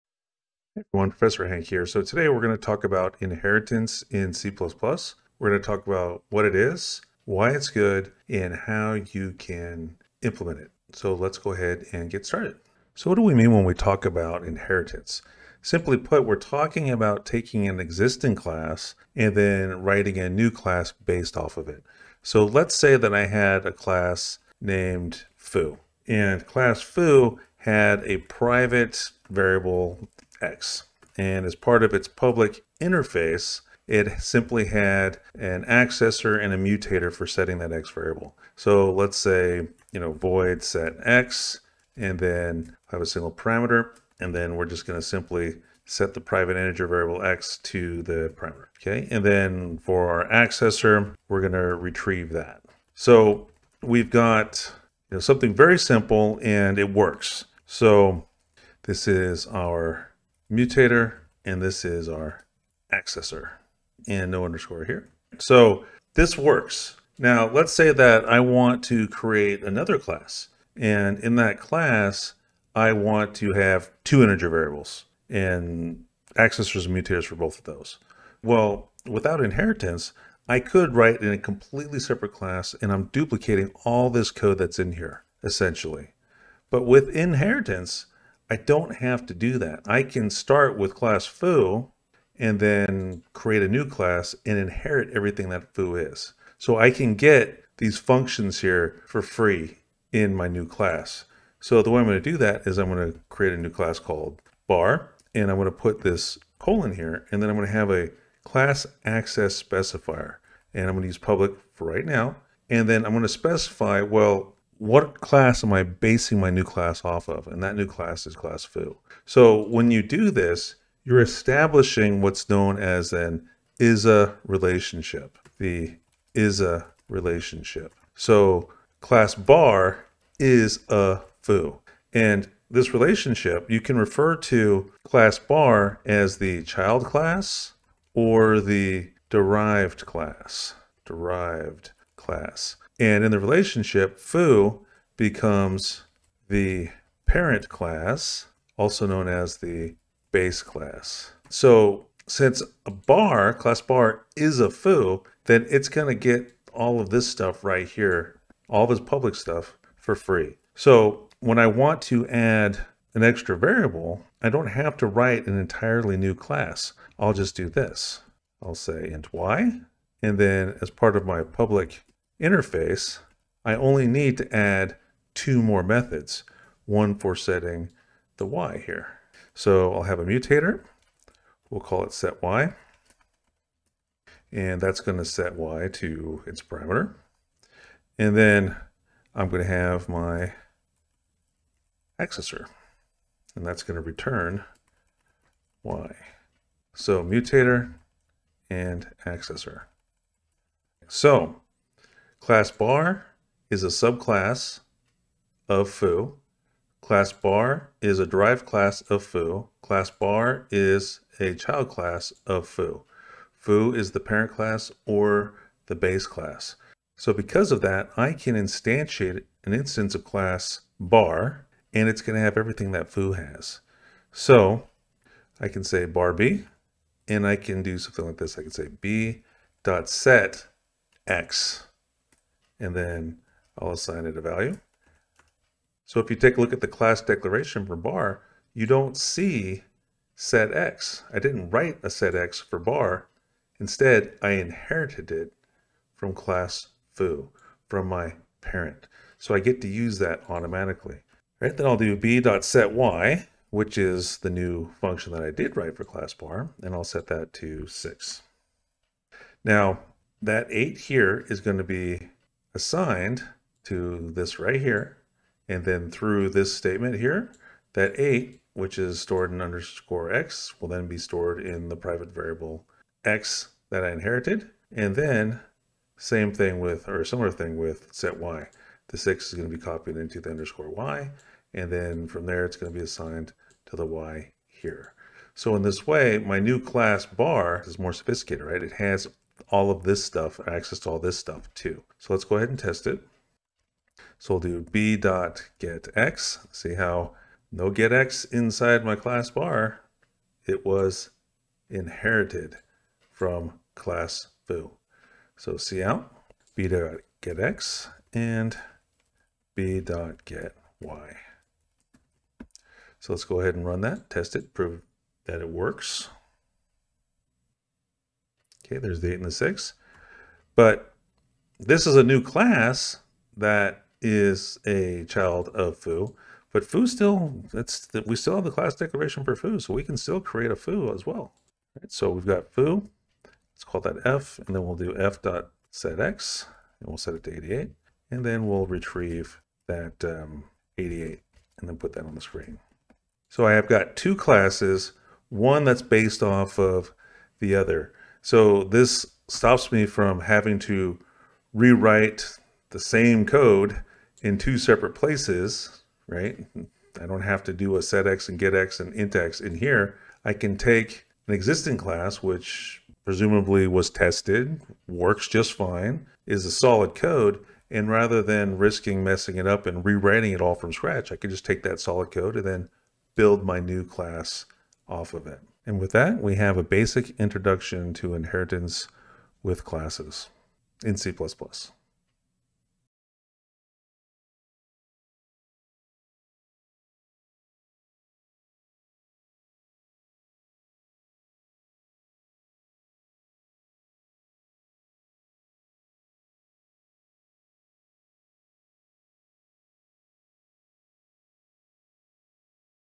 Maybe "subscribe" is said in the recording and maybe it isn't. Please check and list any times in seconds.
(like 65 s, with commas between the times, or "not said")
not said.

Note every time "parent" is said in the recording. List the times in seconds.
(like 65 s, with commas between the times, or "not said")
147 s, 214 s, 248 s.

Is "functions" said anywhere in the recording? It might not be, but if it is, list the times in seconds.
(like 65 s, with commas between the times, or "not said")
97 s, 254 s.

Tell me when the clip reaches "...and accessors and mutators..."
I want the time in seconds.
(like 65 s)
75 s.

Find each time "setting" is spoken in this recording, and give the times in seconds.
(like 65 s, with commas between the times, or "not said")
37 s, 177 s.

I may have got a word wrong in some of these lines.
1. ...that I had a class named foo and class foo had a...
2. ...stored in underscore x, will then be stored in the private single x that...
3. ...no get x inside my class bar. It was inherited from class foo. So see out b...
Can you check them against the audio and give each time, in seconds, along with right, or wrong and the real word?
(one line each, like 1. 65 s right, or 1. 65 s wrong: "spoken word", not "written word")
1. 22 s right
2. 269 s wrong: "variable", not "single"
3. 297 s right.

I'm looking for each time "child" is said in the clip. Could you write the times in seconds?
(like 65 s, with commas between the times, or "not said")
136 s, 211 s, 325 s.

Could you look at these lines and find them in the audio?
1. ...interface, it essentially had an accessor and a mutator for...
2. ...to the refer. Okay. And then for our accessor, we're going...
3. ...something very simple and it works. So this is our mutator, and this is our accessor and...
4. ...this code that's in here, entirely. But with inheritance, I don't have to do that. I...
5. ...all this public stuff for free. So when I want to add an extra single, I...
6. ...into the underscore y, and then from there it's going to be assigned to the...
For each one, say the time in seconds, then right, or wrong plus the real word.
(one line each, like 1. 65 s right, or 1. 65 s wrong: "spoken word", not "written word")
1. 32 s wrong: "simply", not "essentially"
2. 47 s wrong: "parameter", not "refer"
3. 55 s right
4. 84 s wrong: "essentially", not "entirely"
5. 158 s wrong: "variable", not "single"
6. 280 s right.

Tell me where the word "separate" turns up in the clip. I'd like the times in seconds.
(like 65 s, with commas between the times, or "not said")
81 s, 354 s.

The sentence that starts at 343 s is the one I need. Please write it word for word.
So I have got two classes, one that's based off of the other.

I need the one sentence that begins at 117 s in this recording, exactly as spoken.
And that new class is class foo.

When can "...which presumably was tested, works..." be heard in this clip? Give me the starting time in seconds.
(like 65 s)
362 s.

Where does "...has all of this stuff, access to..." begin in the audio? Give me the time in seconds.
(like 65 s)
288 s.